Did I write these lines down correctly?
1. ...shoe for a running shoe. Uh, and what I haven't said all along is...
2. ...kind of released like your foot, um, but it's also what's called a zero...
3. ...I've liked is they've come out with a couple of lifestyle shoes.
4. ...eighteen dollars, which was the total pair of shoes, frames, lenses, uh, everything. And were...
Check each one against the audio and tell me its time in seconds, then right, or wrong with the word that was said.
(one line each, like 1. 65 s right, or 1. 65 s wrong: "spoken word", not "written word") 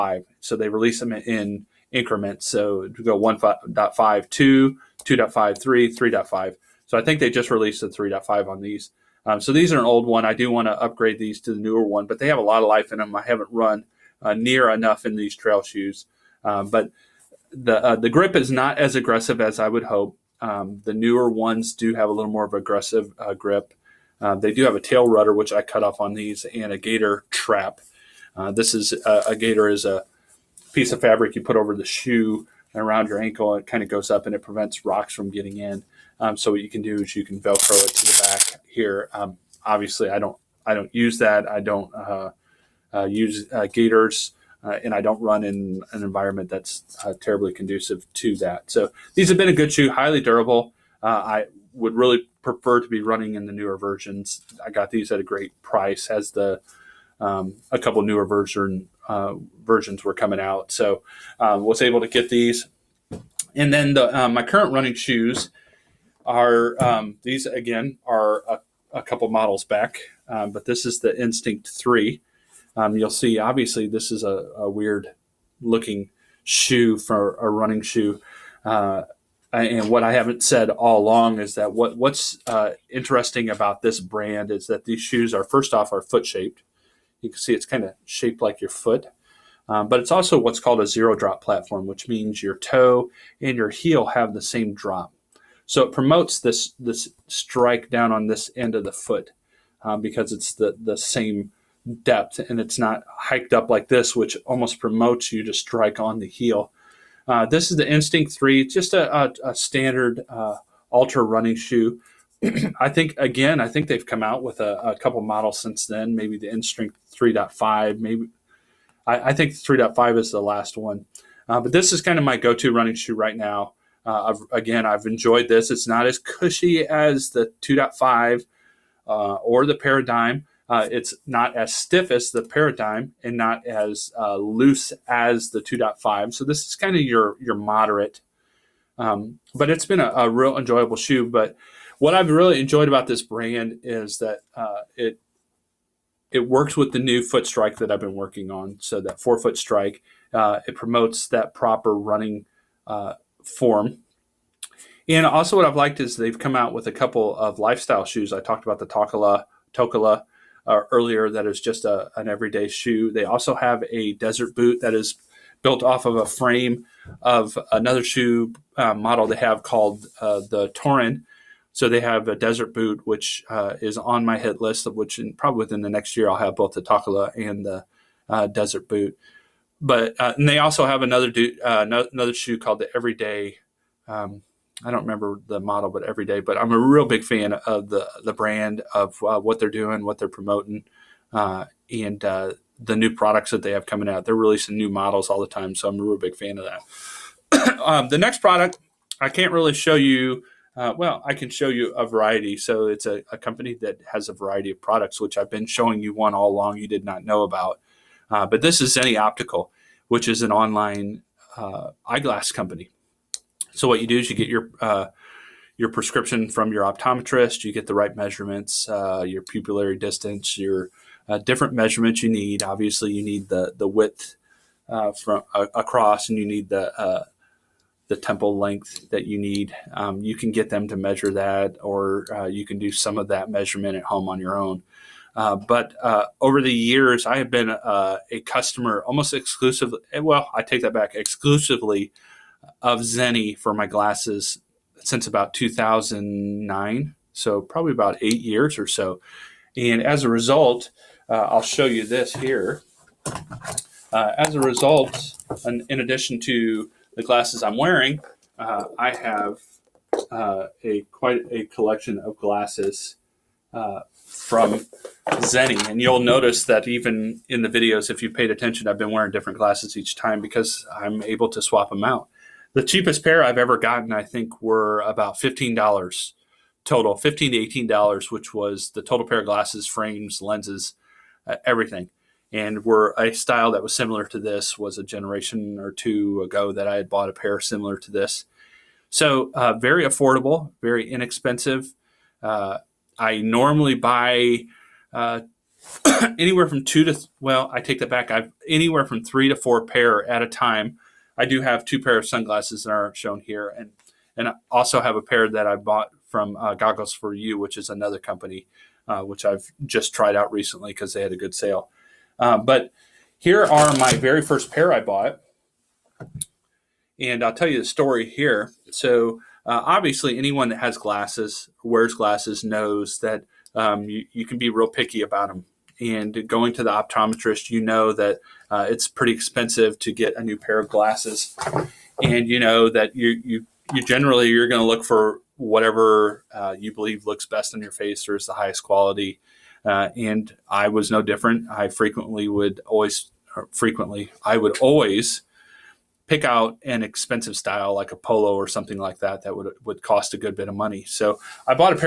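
1. 76 s right
2. 87 s wrong: "shaped", not "released"
3. 155 s right
4. 277 s wrong: "glasses", not "shoes".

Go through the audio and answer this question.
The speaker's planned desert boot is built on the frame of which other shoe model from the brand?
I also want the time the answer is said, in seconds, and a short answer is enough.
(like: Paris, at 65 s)
Torin, at 170 s.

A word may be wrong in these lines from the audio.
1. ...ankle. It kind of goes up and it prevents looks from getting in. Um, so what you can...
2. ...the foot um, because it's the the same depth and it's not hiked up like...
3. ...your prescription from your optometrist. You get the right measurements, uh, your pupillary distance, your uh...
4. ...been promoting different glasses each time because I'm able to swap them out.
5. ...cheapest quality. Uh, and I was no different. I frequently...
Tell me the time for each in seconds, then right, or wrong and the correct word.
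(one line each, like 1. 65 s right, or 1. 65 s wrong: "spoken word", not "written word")
1. 33 s wrong: "rocks", not "looks"
2. 98 s right
3. 215 s right
4. 268 s wrong: "wearing", not "promoting"
5. 338 s wrong: "highest", not "cheapest".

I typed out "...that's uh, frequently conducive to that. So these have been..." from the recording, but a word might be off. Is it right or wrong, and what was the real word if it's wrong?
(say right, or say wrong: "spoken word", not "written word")
wrong: "terribly", not "frequently".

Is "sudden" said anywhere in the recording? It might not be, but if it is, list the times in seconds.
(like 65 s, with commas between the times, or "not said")
not said.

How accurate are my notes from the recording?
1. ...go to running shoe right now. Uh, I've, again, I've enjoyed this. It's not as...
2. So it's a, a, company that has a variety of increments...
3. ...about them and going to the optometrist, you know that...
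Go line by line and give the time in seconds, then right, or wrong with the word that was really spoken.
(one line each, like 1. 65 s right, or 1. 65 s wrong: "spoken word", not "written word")
1. 122 s right
2. 202 s wrong: "products", not "increments"
3. 325 s right.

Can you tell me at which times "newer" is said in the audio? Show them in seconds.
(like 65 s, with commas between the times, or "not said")
11 s, 20 s, 53 s, 58 s.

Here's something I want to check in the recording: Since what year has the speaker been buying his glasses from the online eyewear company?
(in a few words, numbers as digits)
2009.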